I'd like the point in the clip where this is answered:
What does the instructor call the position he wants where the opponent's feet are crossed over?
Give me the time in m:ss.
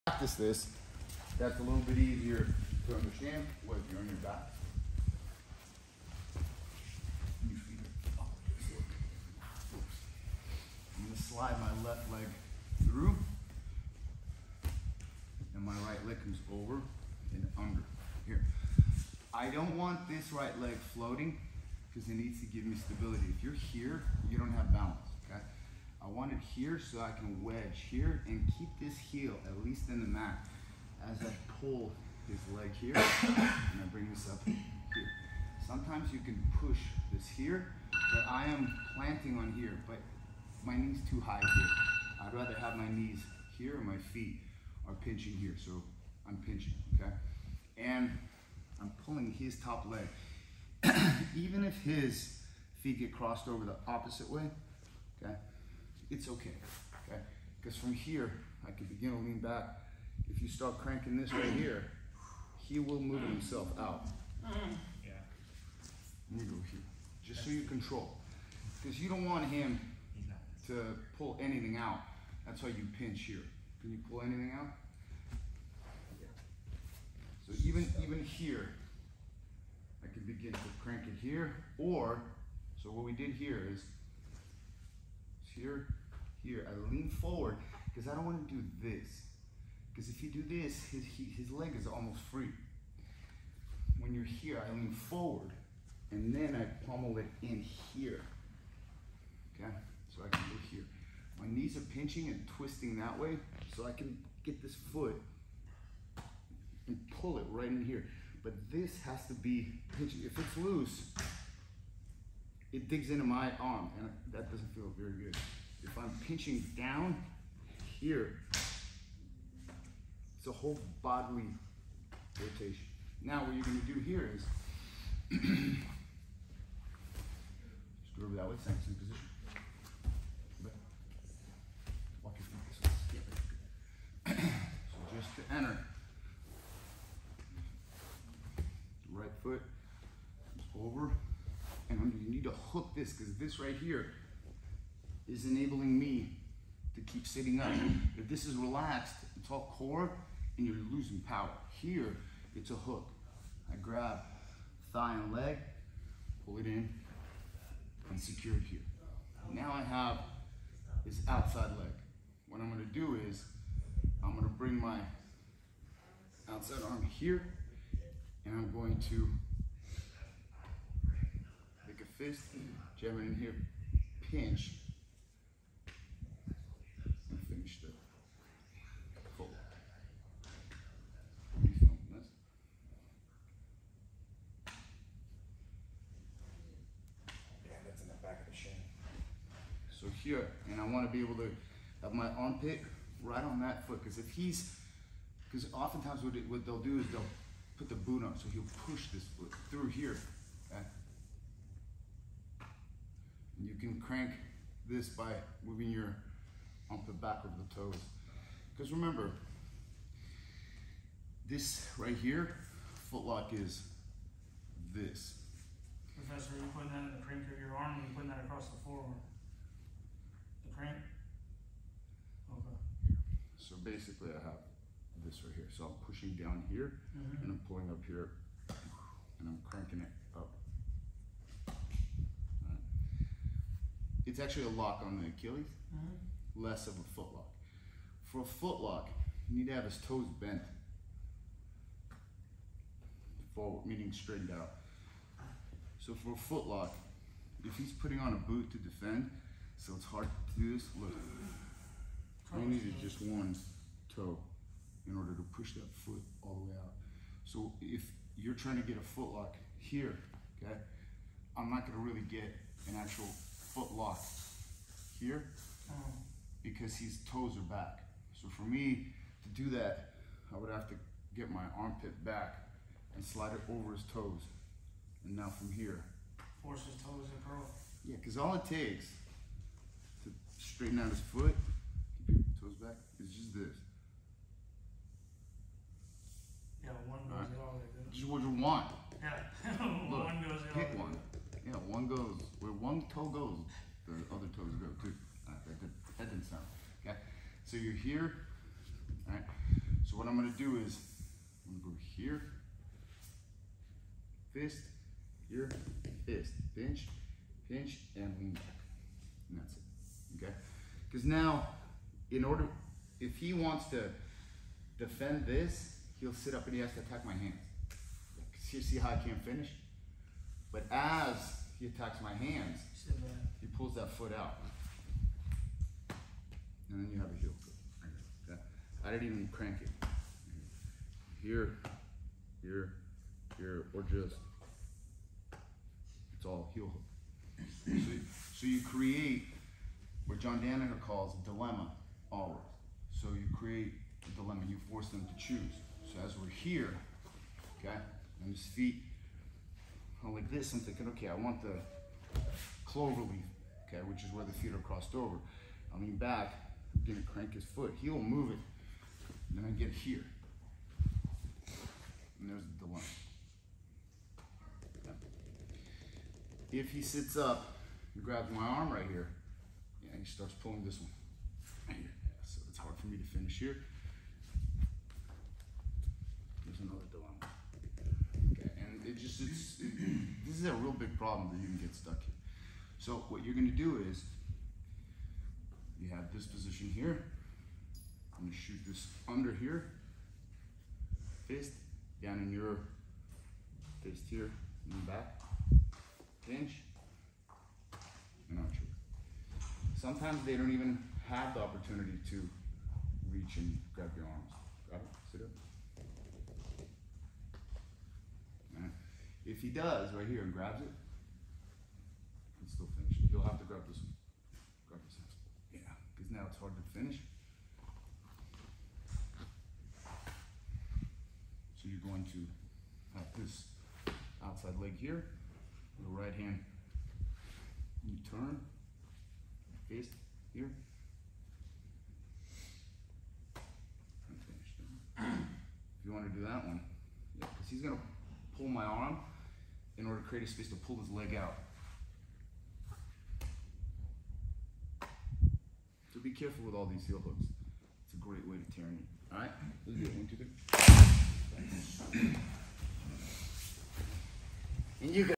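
5:52.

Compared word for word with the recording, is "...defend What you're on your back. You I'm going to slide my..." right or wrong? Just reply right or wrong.
wrong.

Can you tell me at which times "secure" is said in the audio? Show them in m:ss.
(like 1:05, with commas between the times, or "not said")
2:38.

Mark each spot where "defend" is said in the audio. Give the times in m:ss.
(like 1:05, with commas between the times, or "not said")
4:08, 5:14.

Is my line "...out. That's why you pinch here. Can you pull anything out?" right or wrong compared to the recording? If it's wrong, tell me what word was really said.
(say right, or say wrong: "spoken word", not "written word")
right.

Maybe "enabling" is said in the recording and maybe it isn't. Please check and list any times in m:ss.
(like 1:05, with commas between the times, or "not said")
2:25.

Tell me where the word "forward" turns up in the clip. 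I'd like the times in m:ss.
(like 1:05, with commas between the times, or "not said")
1:27, 1:34, 4:03.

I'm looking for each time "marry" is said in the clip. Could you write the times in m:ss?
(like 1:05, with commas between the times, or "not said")
not said.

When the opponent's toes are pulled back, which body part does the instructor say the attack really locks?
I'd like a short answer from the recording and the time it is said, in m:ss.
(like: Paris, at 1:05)
Achilles, at 3:55.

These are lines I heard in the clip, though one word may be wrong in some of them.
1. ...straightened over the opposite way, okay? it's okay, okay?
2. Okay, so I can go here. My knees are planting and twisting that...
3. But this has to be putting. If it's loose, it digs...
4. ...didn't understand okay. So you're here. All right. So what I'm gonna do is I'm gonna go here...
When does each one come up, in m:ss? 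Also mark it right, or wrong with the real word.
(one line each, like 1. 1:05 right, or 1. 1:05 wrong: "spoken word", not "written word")
1. 0:53 wrong: "crossed", not "straightened"
2. 1:39 wrong: "pinching", not "planting"
3. 1:48 wrong: "pinching", not "putting"
4. 4:56 wrong: "sound", not "understand".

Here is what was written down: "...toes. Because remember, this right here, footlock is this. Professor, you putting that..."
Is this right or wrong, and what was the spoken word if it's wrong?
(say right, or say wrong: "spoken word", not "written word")
right.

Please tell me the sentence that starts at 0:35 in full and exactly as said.
Sometimes you can push this here, but I am planting on here, but my knee's too high here.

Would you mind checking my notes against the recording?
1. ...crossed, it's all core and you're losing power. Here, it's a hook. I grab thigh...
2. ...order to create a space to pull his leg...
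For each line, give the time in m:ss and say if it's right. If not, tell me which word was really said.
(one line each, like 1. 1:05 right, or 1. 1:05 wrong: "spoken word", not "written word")
1. 2:28 wrong: "relaxed", not "crossed"
2. 7:20 right.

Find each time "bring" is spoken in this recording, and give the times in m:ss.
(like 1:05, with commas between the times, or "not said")
0:33, 2:44.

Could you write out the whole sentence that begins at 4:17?
So if you're trying to get a foot lock here, okay, I'm not gonna really get an actual foot lock here oh.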